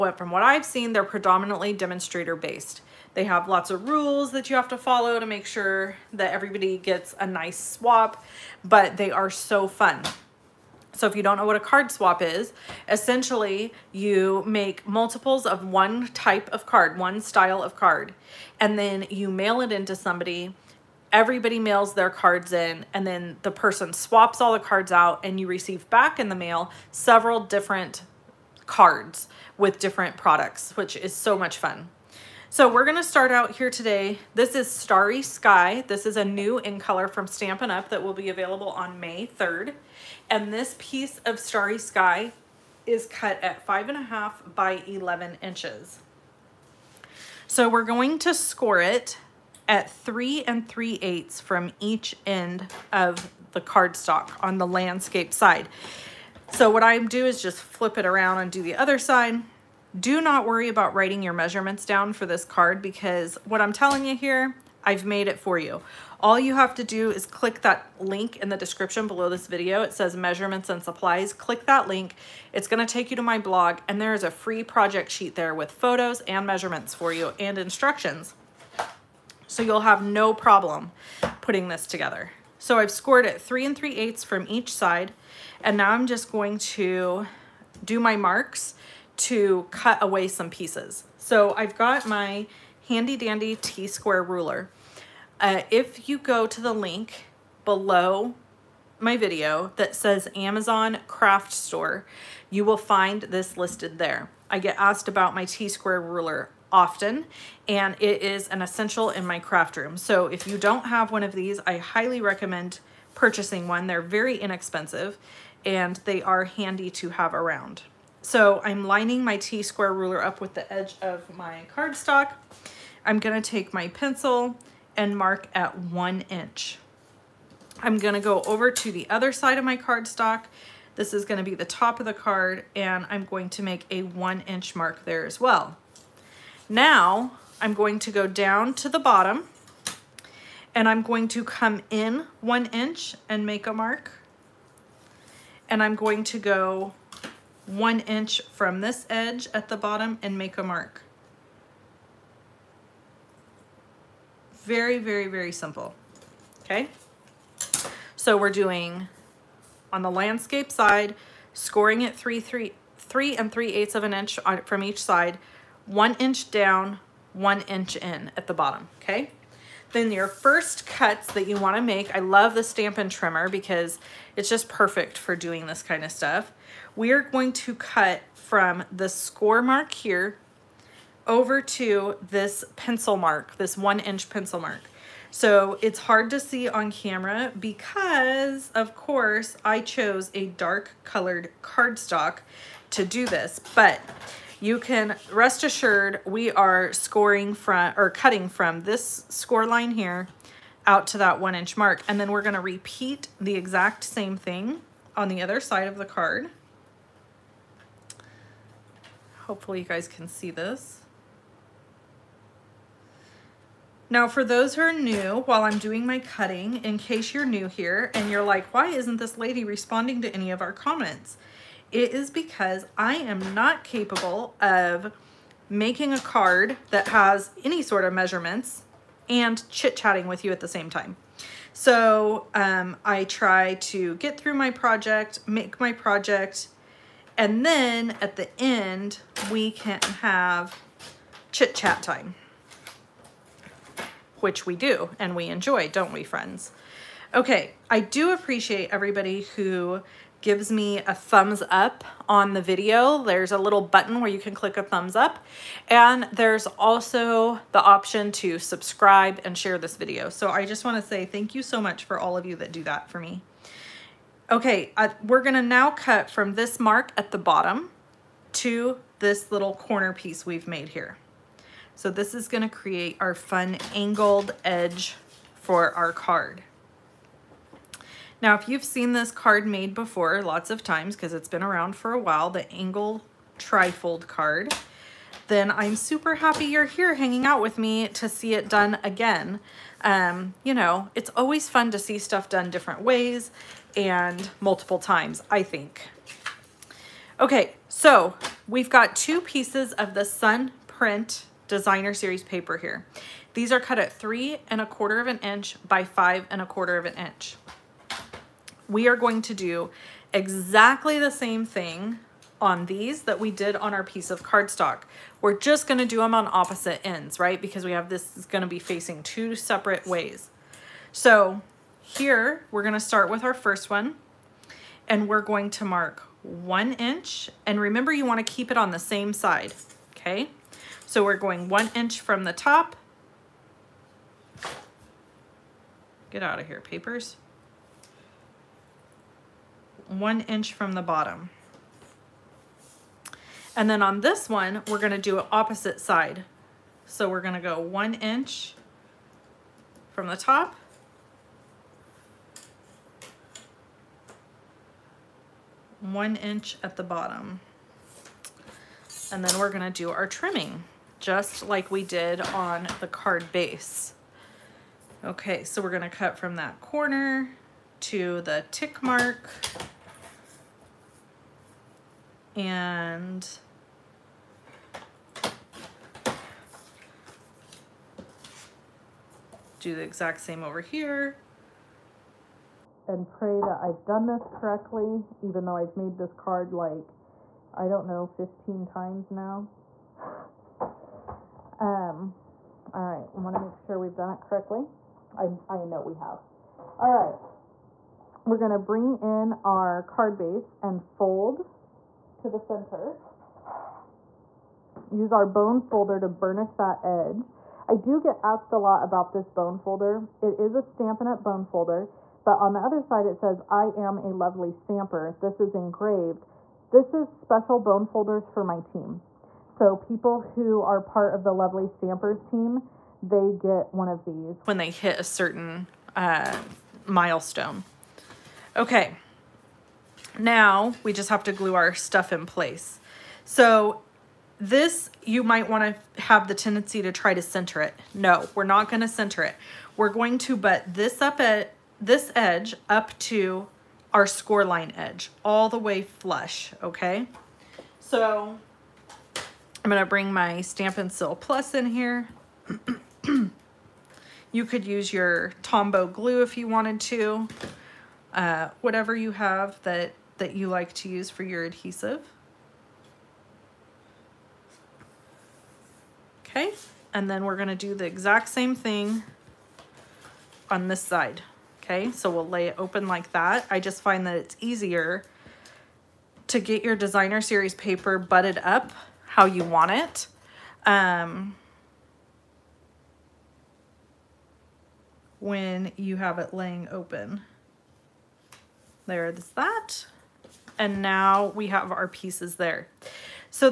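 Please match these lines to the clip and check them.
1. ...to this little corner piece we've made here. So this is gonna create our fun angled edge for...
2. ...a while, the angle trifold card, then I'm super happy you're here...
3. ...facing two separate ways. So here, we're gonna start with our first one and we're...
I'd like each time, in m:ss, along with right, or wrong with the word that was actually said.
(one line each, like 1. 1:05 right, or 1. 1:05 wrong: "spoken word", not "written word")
1. 4:28 right
2. 4:42 right
3. 5:18 right.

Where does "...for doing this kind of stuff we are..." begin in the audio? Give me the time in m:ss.
2:55.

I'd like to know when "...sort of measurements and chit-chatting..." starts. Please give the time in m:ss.
3:47.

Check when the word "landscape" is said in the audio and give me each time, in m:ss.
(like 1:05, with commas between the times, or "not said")
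0:54, 2:40.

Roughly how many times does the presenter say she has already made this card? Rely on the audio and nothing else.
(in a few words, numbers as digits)
15.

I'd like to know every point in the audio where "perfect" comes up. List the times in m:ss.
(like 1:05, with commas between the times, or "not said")
2:54.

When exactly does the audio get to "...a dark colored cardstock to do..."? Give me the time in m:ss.
3:10.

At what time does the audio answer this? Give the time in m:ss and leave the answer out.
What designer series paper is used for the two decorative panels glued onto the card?
5:00.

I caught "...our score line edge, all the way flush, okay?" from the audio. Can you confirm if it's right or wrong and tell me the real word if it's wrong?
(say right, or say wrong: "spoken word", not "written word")
right.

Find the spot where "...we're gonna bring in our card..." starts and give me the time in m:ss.
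6:38.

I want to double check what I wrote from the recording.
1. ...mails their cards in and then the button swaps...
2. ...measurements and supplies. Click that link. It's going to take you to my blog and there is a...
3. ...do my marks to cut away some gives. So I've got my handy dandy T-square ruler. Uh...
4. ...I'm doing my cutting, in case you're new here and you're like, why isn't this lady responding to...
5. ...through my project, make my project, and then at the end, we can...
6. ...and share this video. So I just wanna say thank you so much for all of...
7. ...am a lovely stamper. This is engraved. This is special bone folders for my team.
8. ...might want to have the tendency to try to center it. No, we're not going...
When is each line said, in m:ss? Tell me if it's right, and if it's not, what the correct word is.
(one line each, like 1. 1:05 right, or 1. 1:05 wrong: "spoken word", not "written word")
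1. 0:21 wrong: "person", not "button"
2. 1:10 right
3. 1:27 wrong: "pieces", not "gives"
4. 3:35 right
5. 3:54 right
6. 4:19 right
7. 6:53 right
8. 7:15 right.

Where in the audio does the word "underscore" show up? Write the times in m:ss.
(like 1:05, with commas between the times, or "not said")
not said.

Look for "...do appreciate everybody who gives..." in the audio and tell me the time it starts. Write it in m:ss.
4:07.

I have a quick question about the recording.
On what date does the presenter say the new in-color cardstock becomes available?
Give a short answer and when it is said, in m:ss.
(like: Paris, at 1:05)
May 3rd, at 0:38.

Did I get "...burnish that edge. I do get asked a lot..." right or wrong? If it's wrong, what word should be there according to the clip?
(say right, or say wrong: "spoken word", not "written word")
right.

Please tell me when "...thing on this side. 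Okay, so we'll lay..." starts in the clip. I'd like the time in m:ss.
7:48.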